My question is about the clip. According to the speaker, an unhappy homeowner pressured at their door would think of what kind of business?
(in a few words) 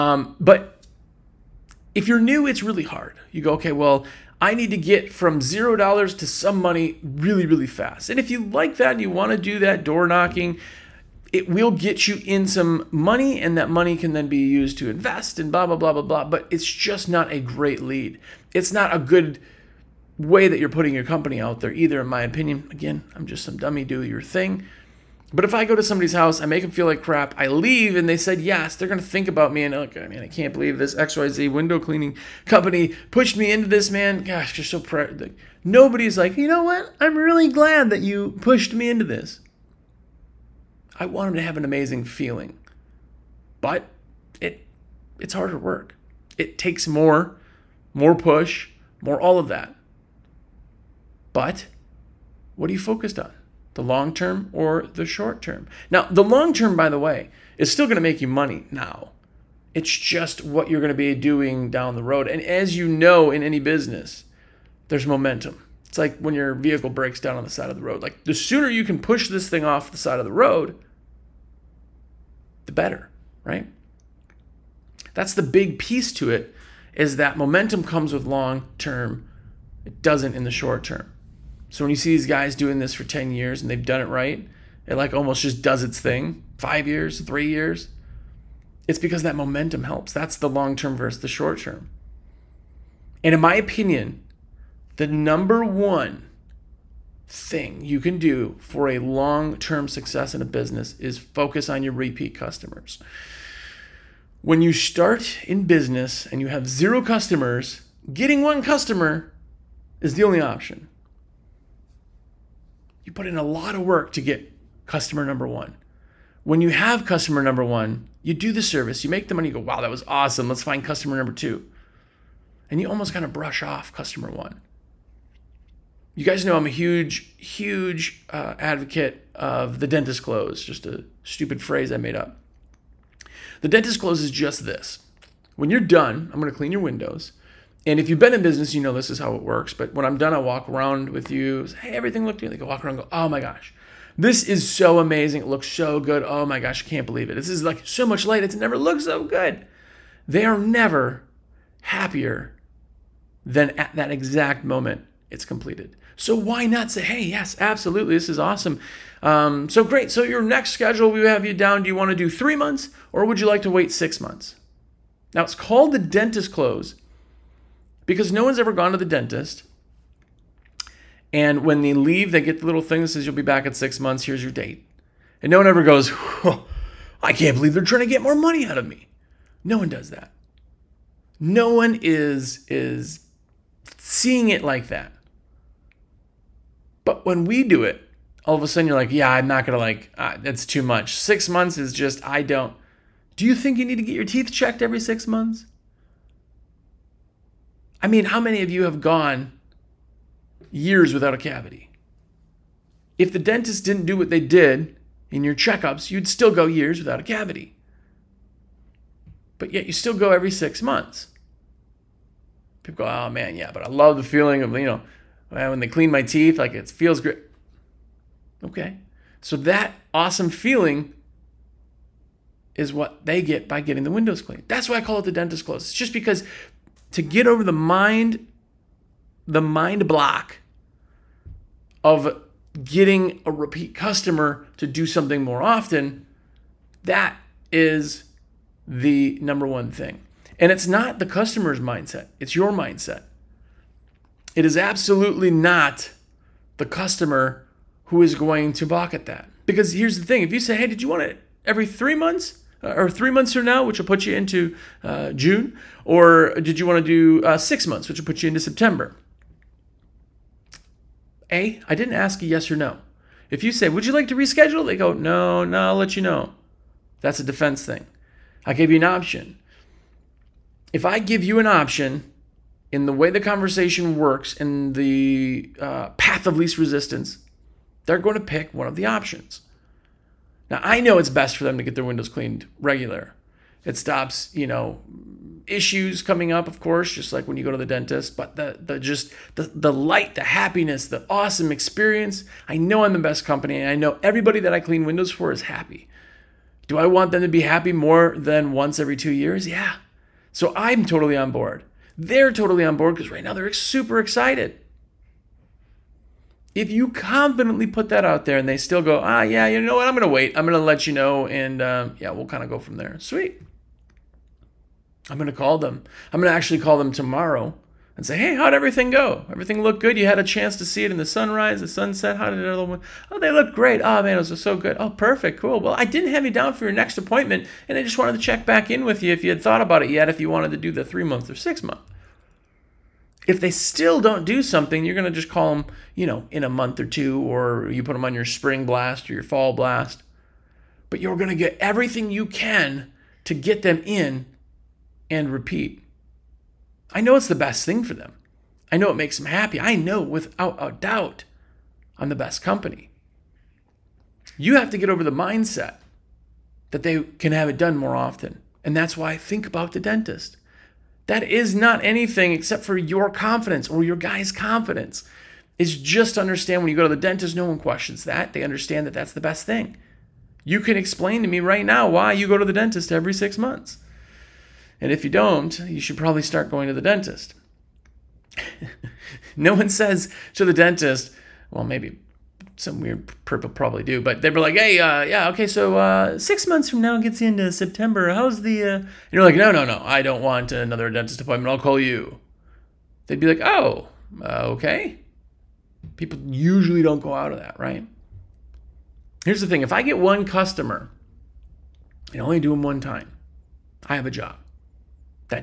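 Window cleaning company.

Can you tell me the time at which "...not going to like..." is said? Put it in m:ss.
3:09.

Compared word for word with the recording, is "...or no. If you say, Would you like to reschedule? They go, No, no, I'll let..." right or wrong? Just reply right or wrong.
right.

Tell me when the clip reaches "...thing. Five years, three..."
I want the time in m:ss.
1:25.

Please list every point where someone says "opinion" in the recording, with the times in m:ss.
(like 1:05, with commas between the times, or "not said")
0:22, 1:33.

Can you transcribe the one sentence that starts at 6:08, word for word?
They understand that that's the best thing.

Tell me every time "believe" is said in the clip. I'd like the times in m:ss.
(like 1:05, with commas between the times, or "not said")
0:30, 2:27, 2:57.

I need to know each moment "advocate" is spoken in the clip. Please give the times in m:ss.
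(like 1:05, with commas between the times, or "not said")
2:08.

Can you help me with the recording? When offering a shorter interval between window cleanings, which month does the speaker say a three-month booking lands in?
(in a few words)
June.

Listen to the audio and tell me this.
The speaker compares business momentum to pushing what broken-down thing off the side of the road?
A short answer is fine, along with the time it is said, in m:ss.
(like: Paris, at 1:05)
Your vehicle, at 1:06.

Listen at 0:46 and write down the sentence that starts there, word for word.
It takes more, more push, more all of that.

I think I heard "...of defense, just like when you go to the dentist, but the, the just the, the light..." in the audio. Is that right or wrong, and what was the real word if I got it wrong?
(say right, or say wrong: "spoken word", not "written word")
wrong: "course", not "defense".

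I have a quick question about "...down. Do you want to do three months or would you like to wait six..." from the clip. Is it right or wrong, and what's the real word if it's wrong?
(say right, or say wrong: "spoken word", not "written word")
right.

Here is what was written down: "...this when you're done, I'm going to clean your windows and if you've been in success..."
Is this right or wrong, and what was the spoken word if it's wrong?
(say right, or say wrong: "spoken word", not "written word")
wrong: "business", not "success".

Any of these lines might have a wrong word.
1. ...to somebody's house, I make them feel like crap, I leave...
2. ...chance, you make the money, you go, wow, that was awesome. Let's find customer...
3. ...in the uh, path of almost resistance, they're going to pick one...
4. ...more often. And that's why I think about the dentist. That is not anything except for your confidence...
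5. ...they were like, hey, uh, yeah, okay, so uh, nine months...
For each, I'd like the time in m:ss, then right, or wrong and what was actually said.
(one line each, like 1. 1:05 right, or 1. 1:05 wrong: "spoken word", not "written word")
1. 0:25 right
2. 1:58 wrong: "service", not "chance"
3. 4:34 wrong: "least", not "almost"
4. 5:57 right
5. 6:24 wrong: "six", not "nine".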